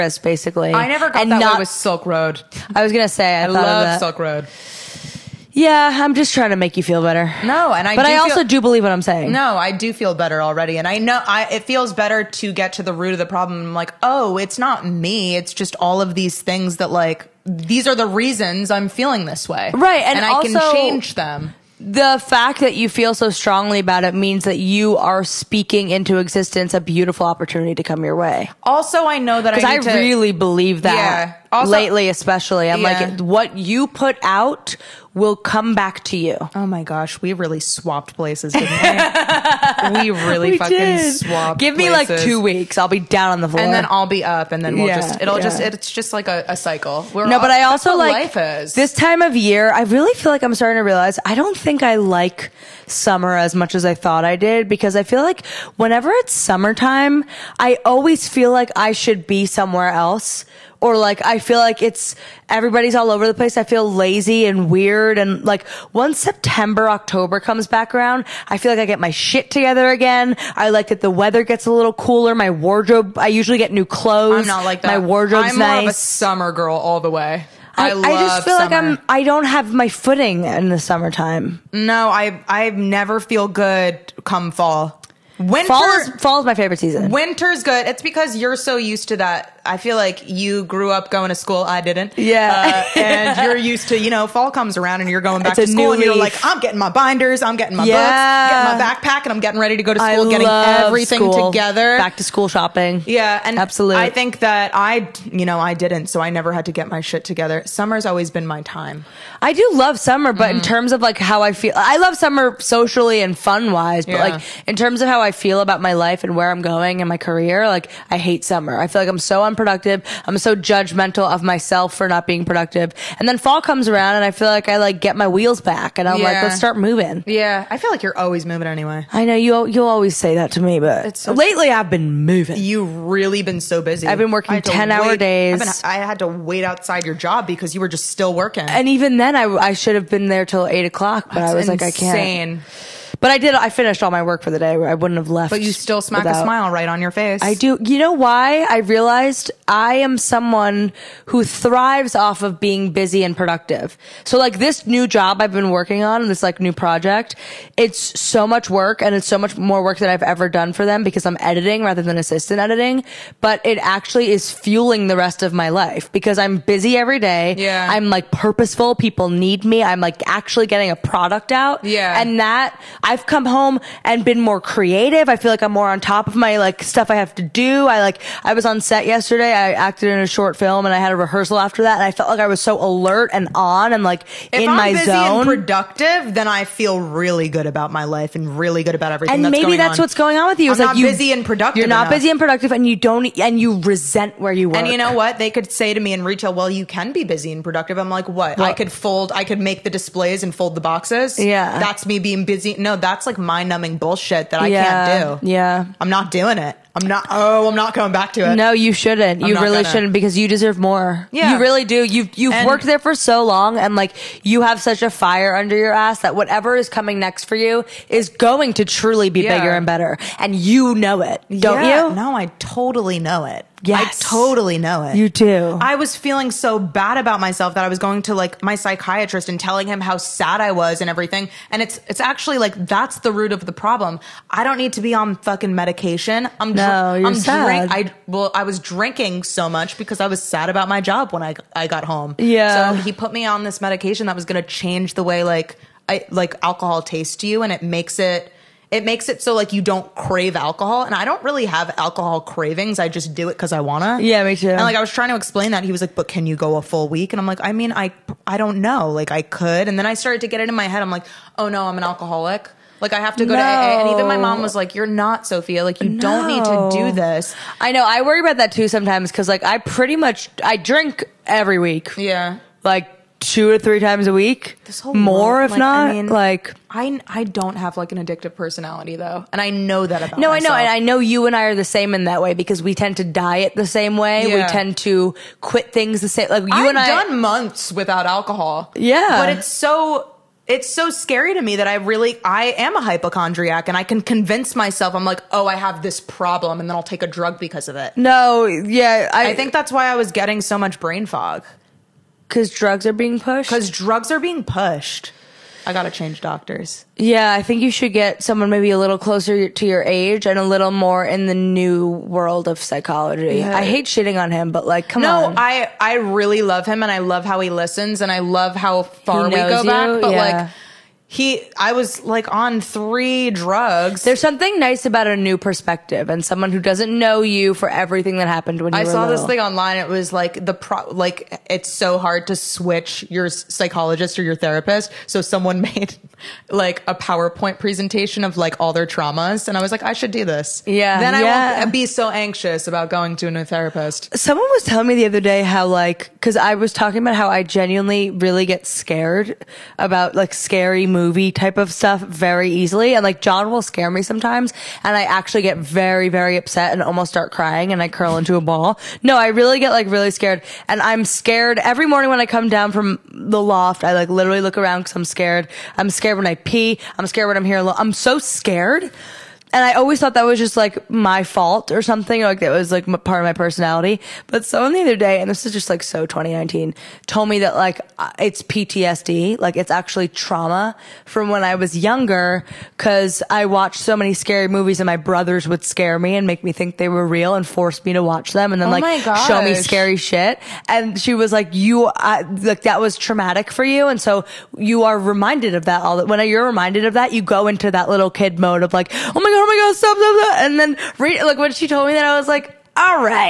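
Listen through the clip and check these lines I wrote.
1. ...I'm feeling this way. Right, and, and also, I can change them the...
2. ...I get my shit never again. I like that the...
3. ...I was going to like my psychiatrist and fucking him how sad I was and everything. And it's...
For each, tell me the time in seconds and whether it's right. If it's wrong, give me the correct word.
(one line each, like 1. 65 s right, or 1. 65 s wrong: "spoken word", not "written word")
1. 18 s right
2. 68 s wrong: "together", not "never"
3. 227 s wrong: "telling", not "fucking".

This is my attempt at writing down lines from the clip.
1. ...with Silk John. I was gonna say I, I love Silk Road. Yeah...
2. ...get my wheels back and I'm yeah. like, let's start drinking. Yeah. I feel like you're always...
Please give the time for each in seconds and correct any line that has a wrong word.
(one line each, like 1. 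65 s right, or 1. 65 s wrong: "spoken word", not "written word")
1. 1 s wrong: "Road", not "John"
2. 124 s wrong: "moving", not "drinking".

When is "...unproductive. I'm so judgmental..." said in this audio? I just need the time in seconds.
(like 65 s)
119 s.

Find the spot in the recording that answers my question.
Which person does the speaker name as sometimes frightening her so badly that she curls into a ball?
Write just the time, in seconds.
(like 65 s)
353 s.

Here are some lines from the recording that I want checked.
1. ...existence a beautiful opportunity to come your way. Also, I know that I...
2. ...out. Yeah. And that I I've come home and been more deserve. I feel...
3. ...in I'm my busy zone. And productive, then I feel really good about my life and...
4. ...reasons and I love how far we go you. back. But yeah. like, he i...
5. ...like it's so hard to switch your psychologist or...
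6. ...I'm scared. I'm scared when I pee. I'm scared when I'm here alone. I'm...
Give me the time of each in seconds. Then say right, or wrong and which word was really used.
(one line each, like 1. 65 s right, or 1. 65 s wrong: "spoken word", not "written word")
1. 26 s right
2. 171 s wrong: "creative", not "deserve"
3. 184 s right
4. 317 s wrong: "listens", not "reasons"
5. 331 s right
6. 365 s right.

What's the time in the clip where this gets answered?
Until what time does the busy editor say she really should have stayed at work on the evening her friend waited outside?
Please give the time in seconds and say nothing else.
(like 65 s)
140 s.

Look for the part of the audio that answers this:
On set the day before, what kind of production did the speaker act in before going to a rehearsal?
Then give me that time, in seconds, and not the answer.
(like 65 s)
180 s.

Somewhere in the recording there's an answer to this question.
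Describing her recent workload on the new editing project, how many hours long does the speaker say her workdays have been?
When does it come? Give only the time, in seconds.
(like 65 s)
134 s.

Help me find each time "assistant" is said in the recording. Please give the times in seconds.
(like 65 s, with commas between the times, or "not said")
162 s.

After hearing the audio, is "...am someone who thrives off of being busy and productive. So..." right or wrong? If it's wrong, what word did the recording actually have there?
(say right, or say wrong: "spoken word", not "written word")
right.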